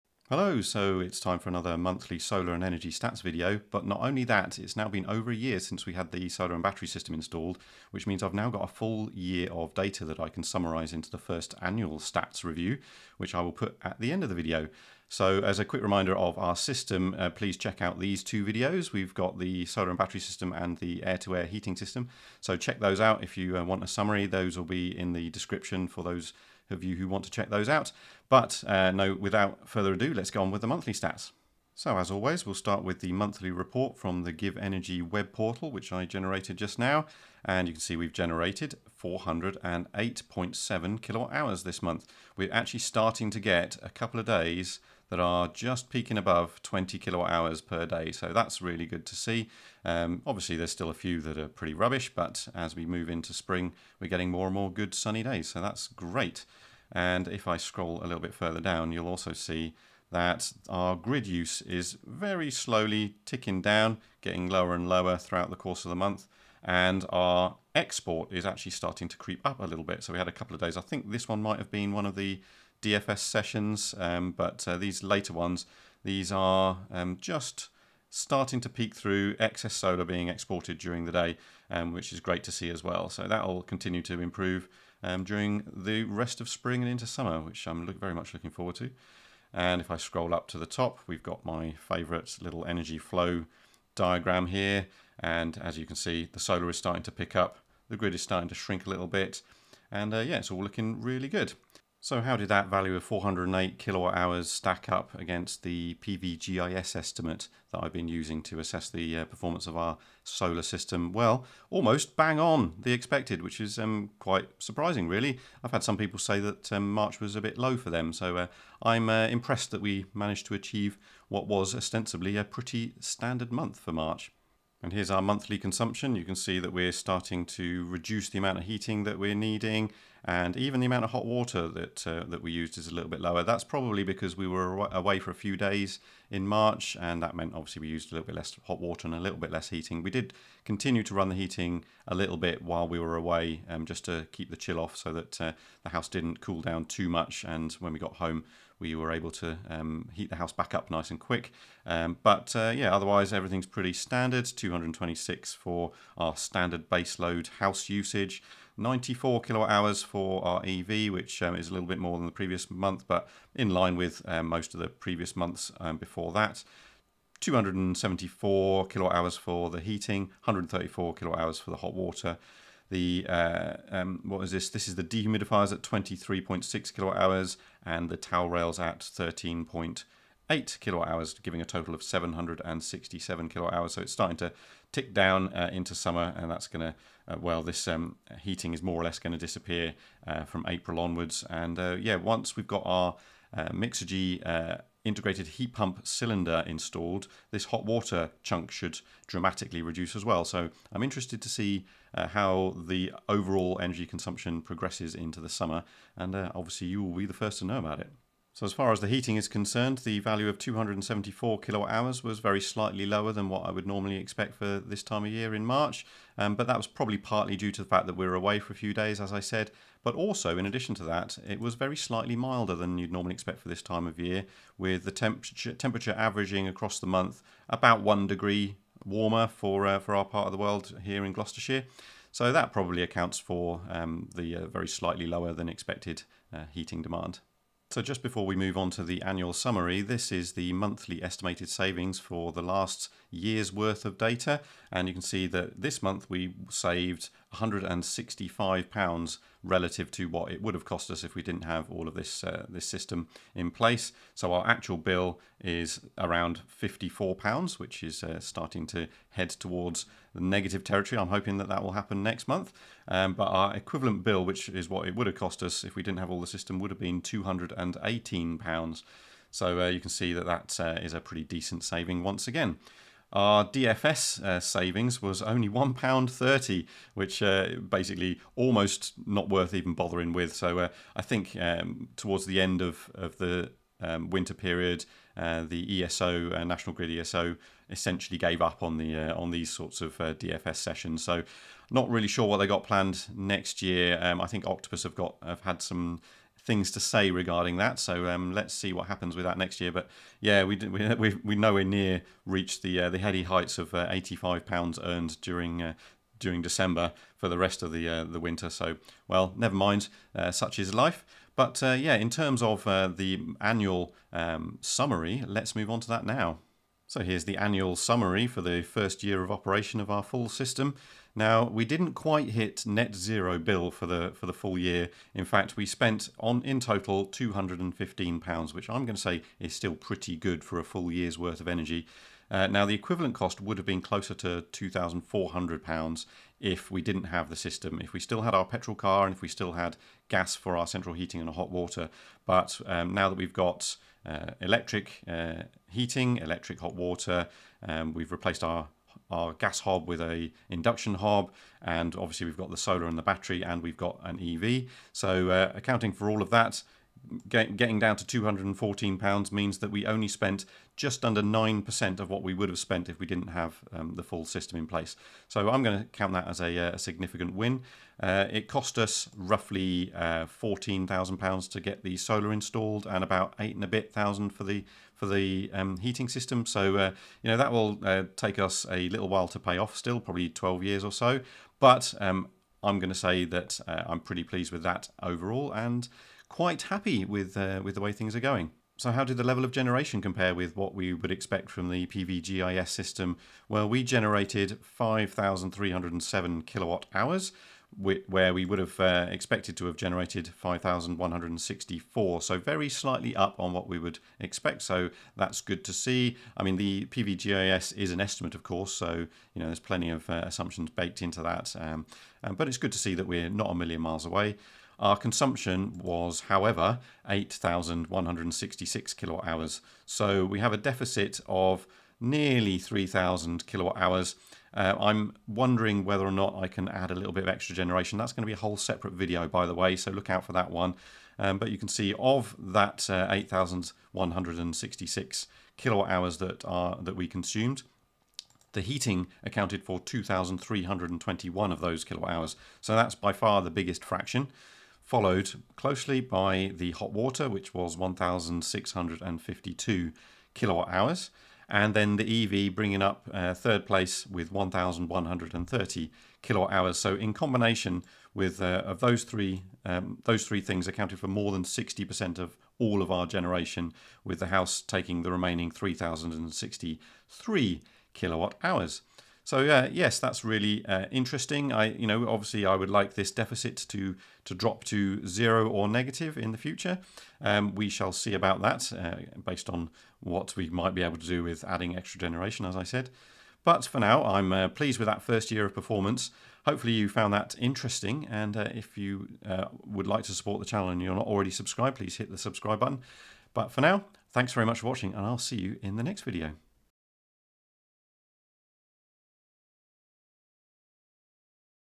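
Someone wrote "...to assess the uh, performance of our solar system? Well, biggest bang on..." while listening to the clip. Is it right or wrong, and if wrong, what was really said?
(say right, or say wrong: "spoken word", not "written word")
wrong: "almost", not "biggest".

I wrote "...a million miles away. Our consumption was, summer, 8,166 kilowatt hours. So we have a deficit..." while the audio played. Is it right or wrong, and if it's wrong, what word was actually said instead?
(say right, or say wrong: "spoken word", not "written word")
wrong: "however", not "summer".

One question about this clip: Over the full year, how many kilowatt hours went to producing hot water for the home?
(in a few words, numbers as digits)
1,652 kWh.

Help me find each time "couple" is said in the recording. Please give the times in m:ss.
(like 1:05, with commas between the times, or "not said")
0:43, 1:10.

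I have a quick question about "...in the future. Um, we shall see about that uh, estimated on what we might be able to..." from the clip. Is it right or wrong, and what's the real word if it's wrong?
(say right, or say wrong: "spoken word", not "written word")
wrong: "based", not "estimated".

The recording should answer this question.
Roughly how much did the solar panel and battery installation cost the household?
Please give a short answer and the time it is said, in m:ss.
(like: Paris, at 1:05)
£14,000, at 6:10.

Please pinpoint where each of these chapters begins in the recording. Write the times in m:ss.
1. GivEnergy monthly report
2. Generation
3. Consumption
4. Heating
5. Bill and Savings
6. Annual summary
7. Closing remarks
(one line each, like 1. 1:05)
1. 0:31
2. 1:41
3. 2:04
4. 3:28
5. 3:57
6. 5:16
7. 8:03.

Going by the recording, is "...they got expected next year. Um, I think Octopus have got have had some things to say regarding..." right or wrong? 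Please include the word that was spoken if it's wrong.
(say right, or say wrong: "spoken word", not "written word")
wrong: "planned", not "expected".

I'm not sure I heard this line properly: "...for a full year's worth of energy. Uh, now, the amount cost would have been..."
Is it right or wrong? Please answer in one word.
wrong.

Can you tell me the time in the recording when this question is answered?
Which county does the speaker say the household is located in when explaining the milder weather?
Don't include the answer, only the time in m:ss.
3:51.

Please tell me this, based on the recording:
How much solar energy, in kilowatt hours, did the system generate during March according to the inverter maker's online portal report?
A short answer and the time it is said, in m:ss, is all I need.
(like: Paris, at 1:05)
408.7 kWh, at 0:39.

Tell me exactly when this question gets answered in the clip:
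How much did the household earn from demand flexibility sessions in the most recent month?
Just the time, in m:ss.
4:35.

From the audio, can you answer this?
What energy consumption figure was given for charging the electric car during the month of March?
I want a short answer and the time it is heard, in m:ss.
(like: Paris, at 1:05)
94 kWh, at 2:38.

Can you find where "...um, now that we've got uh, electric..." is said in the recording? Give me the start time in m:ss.
5:42.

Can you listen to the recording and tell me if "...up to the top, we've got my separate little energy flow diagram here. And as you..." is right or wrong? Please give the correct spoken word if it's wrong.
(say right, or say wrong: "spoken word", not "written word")
wrong: "favorite", not "separate".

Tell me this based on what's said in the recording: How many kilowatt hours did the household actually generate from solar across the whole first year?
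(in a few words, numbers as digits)
5,307 kWh.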